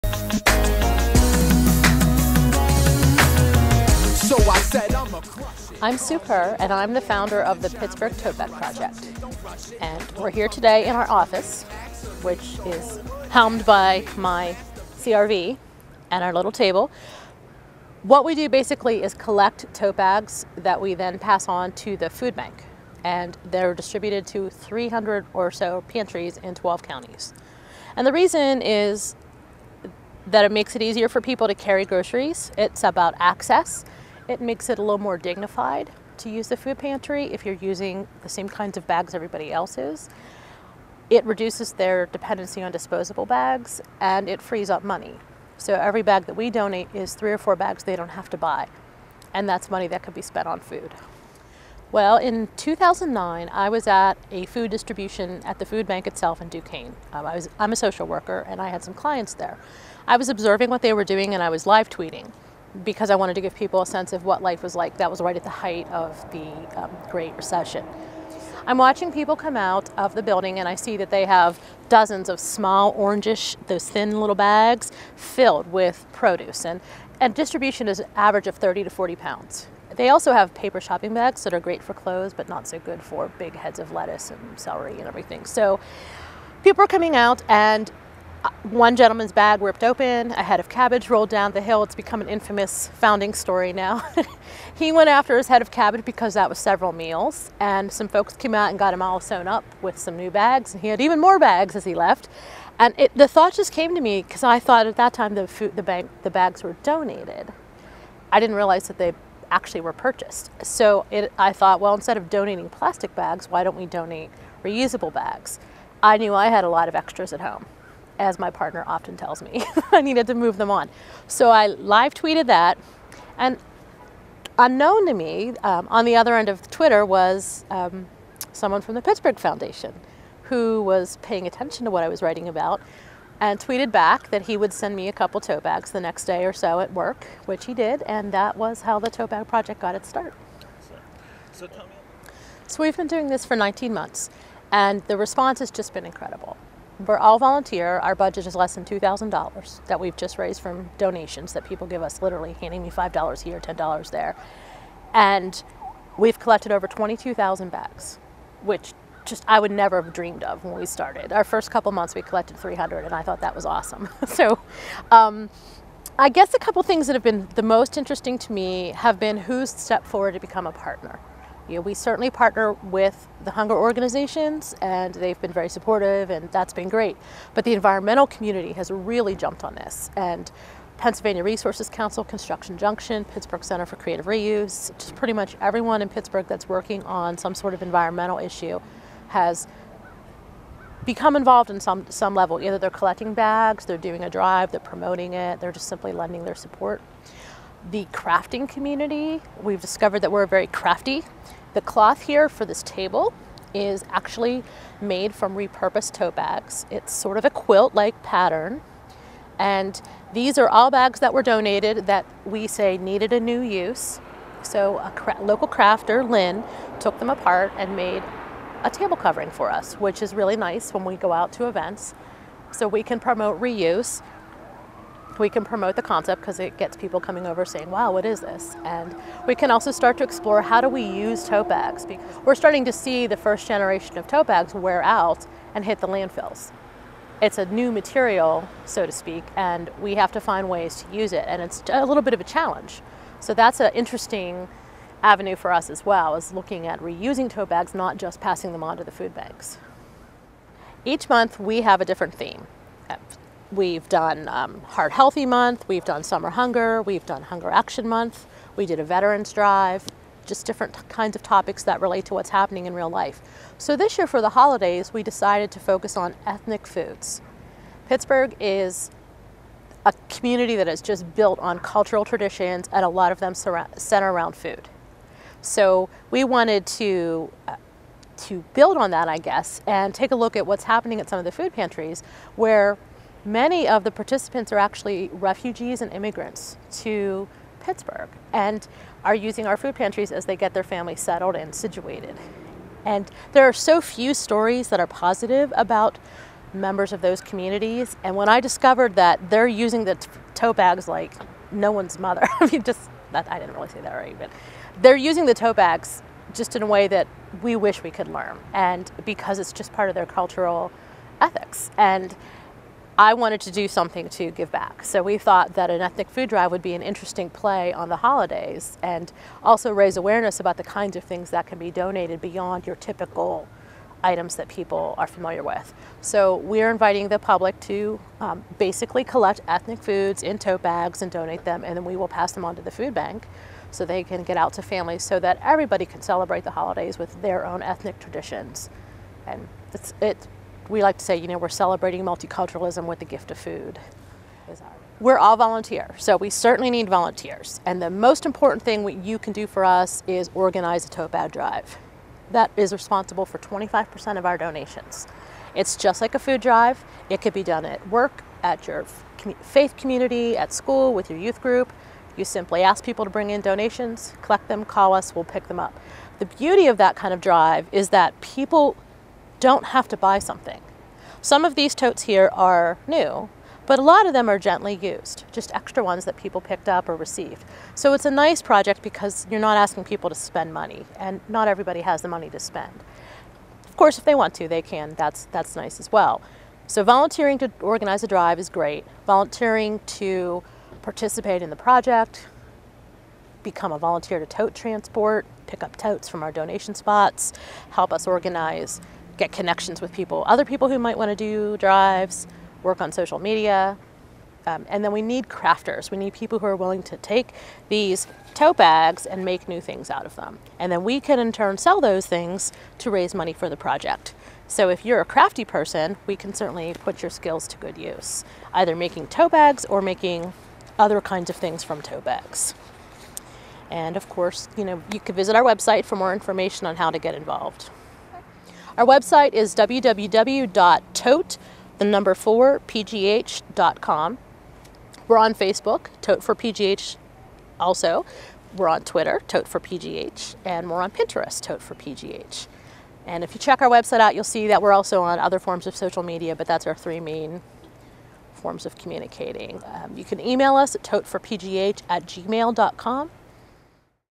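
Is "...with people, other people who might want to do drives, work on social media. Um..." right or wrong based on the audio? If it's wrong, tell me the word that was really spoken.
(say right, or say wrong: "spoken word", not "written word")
right.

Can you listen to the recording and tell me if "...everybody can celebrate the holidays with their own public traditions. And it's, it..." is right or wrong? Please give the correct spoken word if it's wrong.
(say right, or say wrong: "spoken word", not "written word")
wrong: "ethnic", not "public".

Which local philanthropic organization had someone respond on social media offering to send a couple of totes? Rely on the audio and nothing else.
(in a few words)
Pittsburgh Foundation.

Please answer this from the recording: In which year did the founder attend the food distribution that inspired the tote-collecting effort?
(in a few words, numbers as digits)
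2009.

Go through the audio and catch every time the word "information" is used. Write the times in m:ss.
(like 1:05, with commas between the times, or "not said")
7:06.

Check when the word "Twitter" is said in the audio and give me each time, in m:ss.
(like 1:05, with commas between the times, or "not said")
2:06, 7:19.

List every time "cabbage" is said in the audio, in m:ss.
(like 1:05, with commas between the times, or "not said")
1:30, 1:35.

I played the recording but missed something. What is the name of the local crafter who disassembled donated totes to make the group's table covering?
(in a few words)
Lynn.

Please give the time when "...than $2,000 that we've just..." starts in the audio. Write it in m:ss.
2:28.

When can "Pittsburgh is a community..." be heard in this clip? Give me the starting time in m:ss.
4:28.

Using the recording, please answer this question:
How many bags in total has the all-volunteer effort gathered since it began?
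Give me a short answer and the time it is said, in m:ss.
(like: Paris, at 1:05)
22,000, at 2:36.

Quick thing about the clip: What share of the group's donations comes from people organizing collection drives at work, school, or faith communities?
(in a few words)
25%.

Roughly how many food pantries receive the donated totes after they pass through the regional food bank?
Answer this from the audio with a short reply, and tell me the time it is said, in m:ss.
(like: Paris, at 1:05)
300, at 0:24.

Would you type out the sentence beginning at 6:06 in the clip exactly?
The beauty of that kind of drive is that people don't have to buy something.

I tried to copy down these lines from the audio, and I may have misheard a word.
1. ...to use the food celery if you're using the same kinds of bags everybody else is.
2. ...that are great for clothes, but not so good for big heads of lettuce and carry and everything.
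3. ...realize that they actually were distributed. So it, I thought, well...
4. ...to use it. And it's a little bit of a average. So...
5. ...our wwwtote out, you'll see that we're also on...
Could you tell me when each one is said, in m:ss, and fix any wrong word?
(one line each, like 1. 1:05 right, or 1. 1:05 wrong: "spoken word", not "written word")
1. 0:36 wrong: "pantry", not "celery"
2. 1:21 wrong: "celery", not "carry"
3. 1:48 wrong: "purchased", not "distributed"
4. 4:01 wrong: "challenge", not "average"
5. 7:23 wrong: "website", not "wwwtote".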